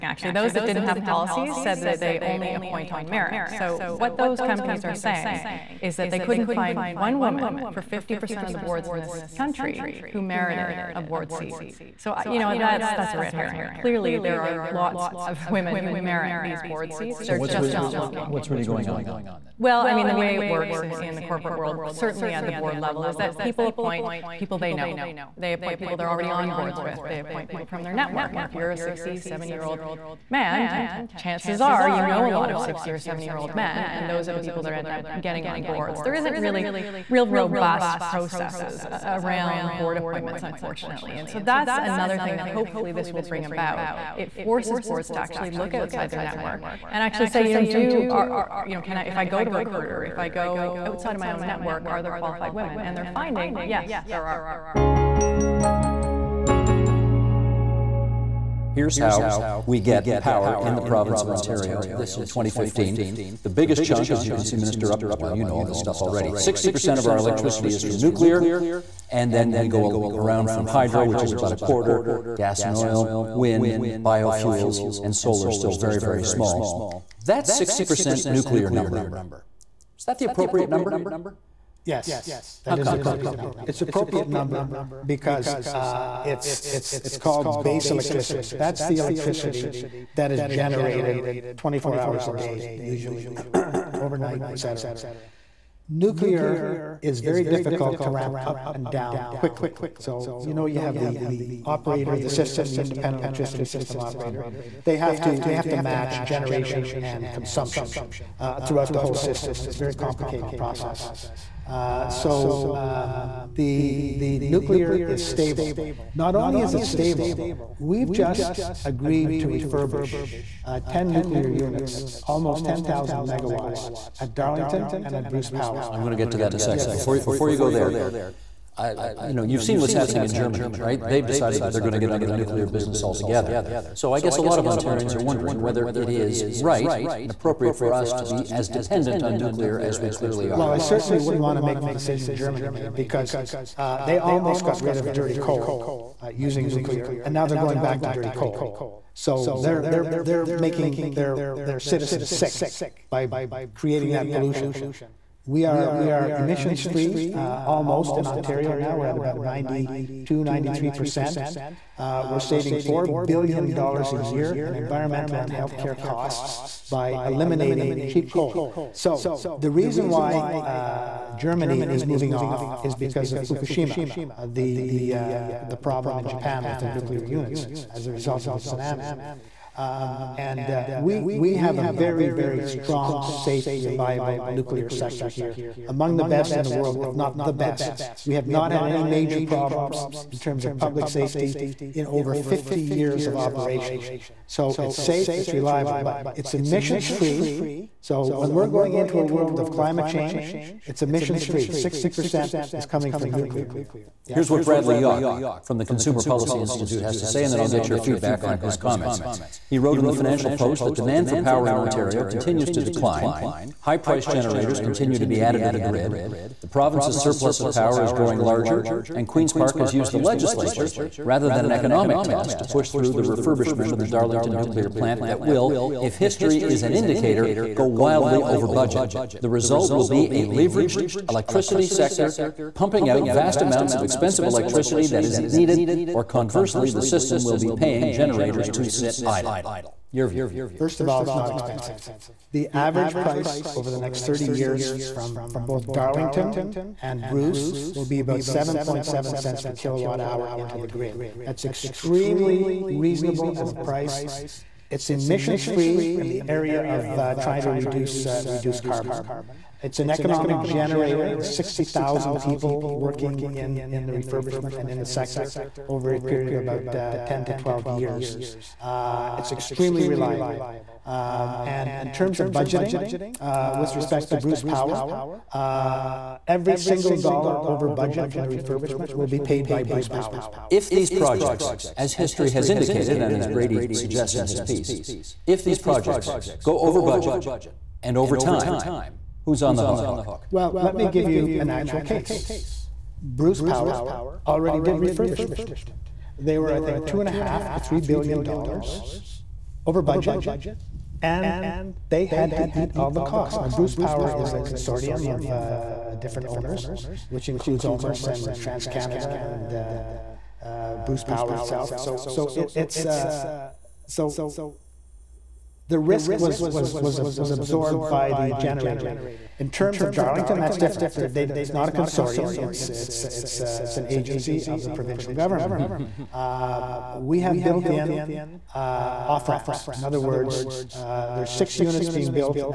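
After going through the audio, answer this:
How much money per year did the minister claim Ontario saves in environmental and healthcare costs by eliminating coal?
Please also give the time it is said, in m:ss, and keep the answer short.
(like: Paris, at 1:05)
4 billion dollars, at 2:42.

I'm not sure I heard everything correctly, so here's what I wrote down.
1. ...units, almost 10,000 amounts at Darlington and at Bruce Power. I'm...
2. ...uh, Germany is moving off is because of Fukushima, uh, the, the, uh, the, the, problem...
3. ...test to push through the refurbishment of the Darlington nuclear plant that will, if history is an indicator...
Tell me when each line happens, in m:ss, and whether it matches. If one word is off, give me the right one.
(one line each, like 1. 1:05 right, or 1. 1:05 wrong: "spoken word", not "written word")
1. 2:01 wrong: "megawatts", not "amounts"
2. 2:50 right
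3. 3:42 right.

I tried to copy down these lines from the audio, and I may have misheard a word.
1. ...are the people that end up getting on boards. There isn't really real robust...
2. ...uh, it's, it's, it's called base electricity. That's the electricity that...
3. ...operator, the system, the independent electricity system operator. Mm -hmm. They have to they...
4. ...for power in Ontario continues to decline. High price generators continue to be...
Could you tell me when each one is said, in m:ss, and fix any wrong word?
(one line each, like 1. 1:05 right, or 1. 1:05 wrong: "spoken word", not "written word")
1. 0:34 right
2. 1:25 right
3. 1:41 right
4. 3:31 right.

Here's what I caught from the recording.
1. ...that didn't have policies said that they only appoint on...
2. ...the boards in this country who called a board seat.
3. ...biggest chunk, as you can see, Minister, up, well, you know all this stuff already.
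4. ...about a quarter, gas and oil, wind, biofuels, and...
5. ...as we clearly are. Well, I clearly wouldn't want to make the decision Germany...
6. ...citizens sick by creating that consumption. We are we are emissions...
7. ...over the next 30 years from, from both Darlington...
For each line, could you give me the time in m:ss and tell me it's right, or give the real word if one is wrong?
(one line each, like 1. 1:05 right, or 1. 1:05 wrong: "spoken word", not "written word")
1. 0:00 right
2. 0:08 wrong: "merited", not "called"
3. 1:03 right
4. 1:11 right
5. 2:19 wrong: "certainly", not "clearly"
6. 2:31 wrong: "pollution", not "consumption"
7. 4:03 right.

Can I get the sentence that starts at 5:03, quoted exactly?
Now, Bruce Power is a consortium of uh, uh, different owners, which includes OMERS and TransCanada and uh, uh, Bruce Power itself.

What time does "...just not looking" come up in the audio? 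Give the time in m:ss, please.
0:17.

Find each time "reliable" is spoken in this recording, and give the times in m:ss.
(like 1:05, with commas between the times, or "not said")
3:03, 3:15, 4:30.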